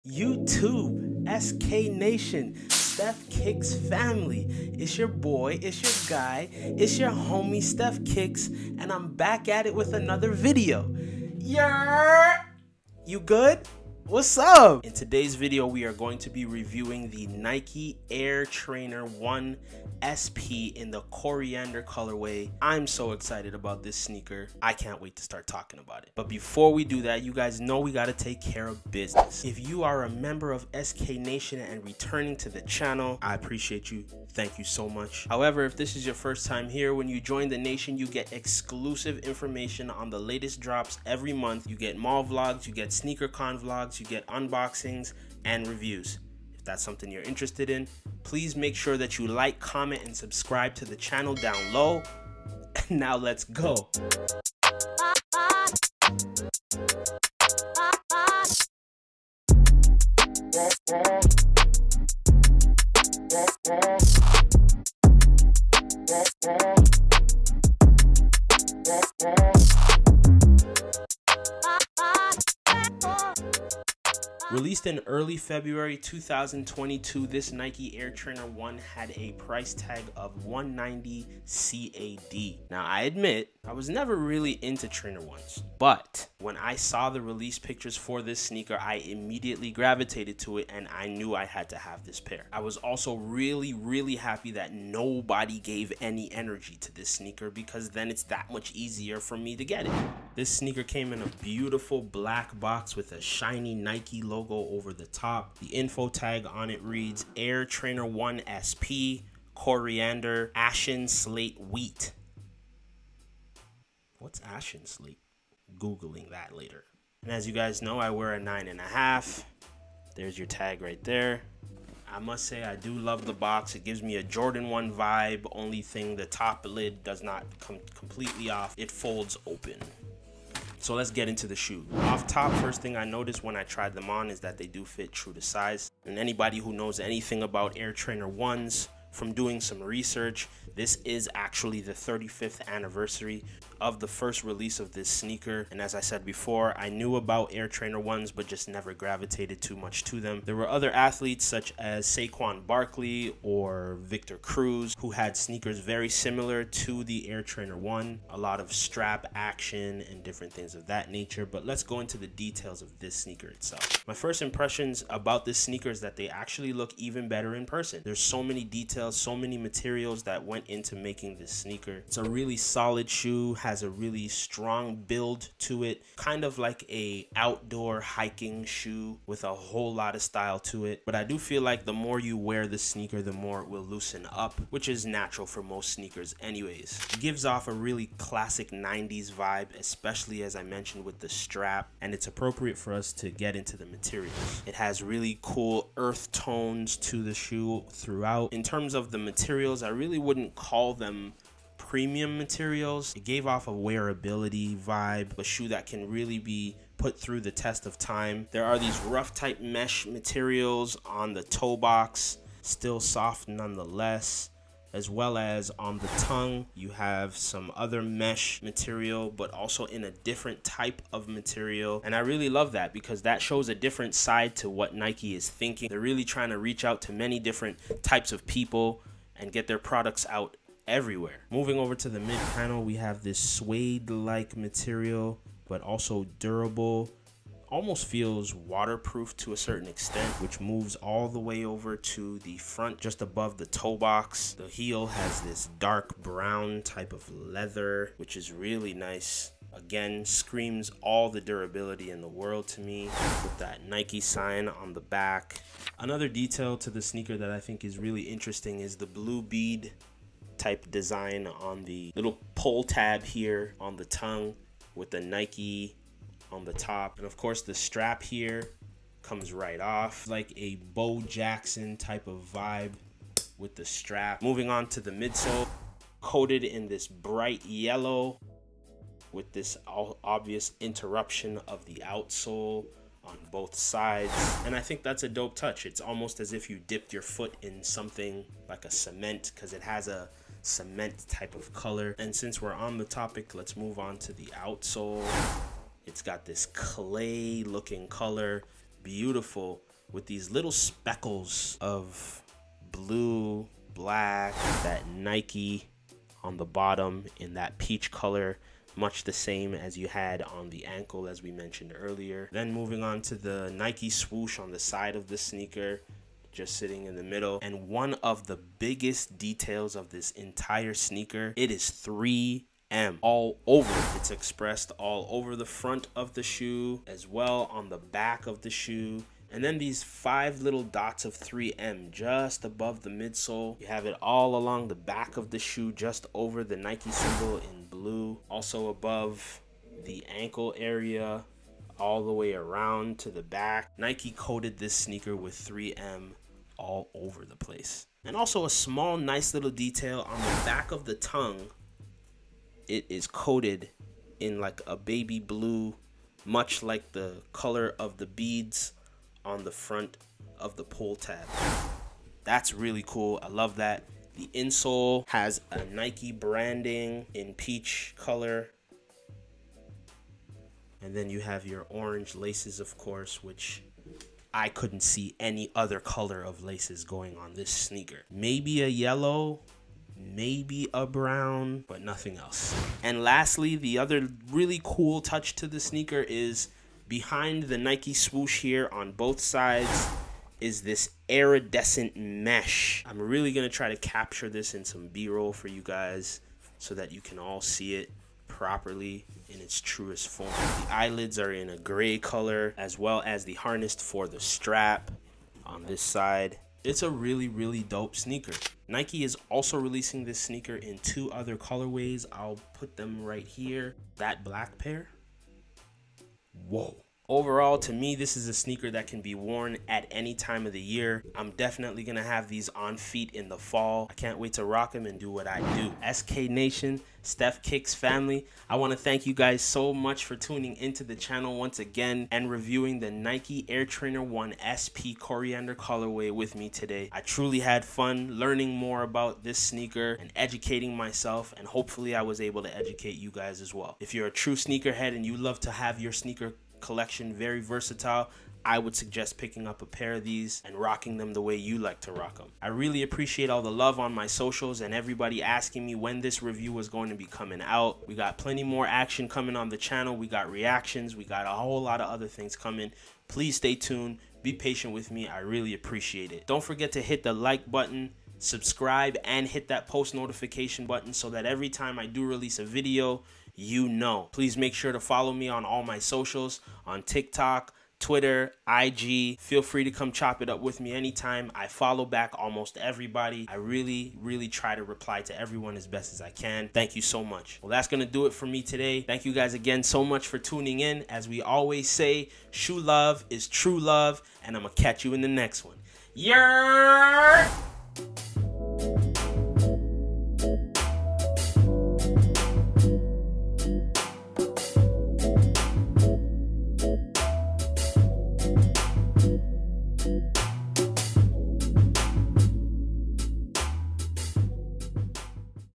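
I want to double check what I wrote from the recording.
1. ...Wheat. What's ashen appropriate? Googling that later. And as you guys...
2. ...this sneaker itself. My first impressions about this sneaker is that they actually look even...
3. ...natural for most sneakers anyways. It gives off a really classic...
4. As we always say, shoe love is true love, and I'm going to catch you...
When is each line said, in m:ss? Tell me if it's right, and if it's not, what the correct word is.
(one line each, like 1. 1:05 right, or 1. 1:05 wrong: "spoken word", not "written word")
1. 1:51 wrong: "slate", not "appropriate"
2. 2:42 right
3. 3:05 right
4. 8:11 right.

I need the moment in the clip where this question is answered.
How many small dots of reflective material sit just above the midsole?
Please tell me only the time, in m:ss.
5:30.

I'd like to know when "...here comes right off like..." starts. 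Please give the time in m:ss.
4:28.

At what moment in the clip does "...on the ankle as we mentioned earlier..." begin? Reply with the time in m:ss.
5:10.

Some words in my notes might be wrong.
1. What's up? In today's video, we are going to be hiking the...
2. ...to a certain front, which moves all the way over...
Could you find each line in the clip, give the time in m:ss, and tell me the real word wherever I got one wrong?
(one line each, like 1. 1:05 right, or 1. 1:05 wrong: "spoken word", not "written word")
1. 0:14 wrong: "reviewing", not "hiking"
2. 3:59 wrong: "extent", not "front".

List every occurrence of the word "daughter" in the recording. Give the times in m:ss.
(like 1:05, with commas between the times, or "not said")
not said.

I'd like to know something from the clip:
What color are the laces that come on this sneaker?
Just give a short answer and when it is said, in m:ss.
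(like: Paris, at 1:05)
Orange, at 6:11.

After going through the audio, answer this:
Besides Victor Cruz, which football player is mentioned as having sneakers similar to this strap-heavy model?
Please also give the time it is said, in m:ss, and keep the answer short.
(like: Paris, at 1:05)
Saquon Barkley, at 2:32.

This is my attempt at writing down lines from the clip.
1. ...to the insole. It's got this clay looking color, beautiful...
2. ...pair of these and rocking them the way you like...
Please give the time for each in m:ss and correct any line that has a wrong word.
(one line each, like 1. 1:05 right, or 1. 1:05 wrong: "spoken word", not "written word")
1. 4:54 wrong: "outsole", not "insole"
2. 7:29 right.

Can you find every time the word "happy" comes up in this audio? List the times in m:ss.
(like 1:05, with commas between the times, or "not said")
1:34.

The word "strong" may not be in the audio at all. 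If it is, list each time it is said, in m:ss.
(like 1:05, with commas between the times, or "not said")
2:54.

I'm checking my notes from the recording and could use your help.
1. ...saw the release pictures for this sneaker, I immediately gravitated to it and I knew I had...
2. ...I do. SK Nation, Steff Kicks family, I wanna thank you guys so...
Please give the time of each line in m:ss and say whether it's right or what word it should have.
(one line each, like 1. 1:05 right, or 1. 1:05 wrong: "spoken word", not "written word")
1. 1:26 right
2. 7:05 right.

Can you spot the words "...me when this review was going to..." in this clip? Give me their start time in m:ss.
7:35.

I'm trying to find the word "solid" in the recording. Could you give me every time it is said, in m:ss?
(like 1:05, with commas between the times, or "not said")
2:52.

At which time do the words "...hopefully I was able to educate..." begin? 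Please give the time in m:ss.
7:21.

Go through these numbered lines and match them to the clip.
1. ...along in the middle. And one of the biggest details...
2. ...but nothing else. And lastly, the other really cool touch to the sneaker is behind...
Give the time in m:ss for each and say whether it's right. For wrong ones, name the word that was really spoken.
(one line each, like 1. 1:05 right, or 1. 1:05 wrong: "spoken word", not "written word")
1. 5:16 wrong: "sitting", not "along"
2. 6:21 right.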